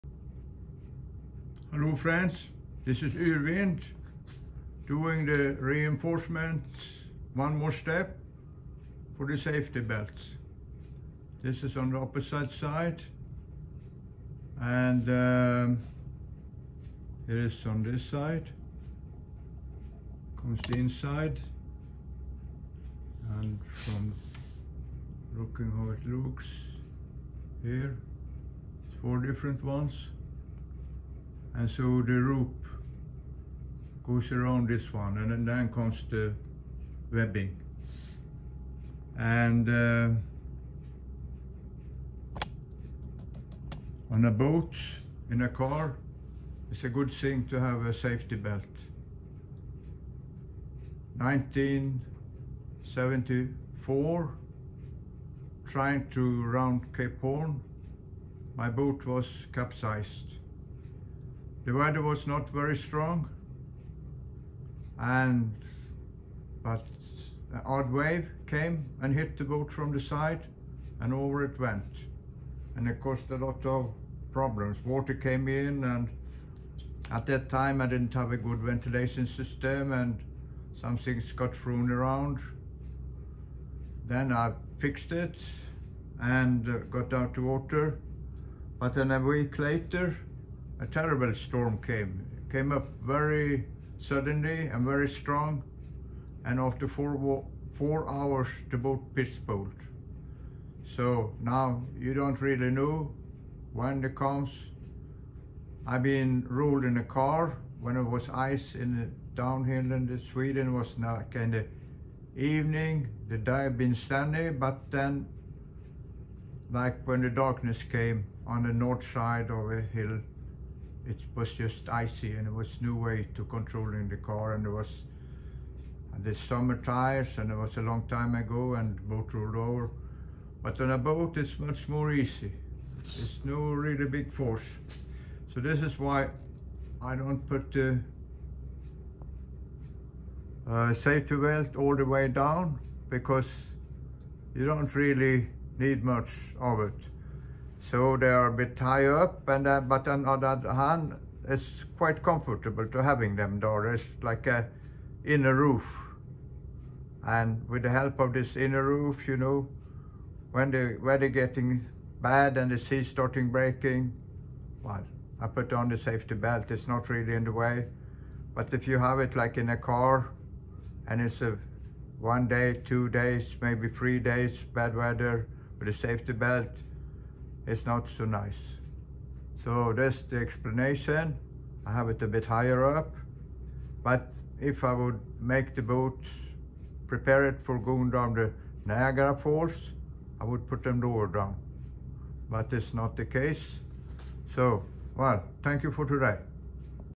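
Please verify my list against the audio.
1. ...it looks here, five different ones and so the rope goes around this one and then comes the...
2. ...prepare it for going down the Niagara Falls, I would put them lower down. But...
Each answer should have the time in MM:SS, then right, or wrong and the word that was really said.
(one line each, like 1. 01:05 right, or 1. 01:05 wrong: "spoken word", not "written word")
1. 00:25 wrong: "four", not "five"
2. 03:07 right.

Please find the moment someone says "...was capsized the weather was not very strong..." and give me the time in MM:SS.
00:59.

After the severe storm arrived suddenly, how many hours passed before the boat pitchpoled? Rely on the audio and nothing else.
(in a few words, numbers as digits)
4.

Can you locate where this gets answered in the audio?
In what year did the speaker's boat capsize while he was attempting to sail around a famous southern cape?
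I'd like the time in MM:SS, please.
00:51.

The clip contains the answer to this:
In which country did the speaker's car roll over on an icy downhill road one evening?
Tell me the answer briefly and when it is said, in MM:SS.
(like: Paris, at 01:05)
Sweden, at 01:50.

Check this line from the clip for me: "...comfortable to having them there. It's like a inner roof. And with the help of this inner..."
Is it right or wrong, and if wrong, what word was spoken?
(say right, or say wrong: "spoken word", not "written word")
right.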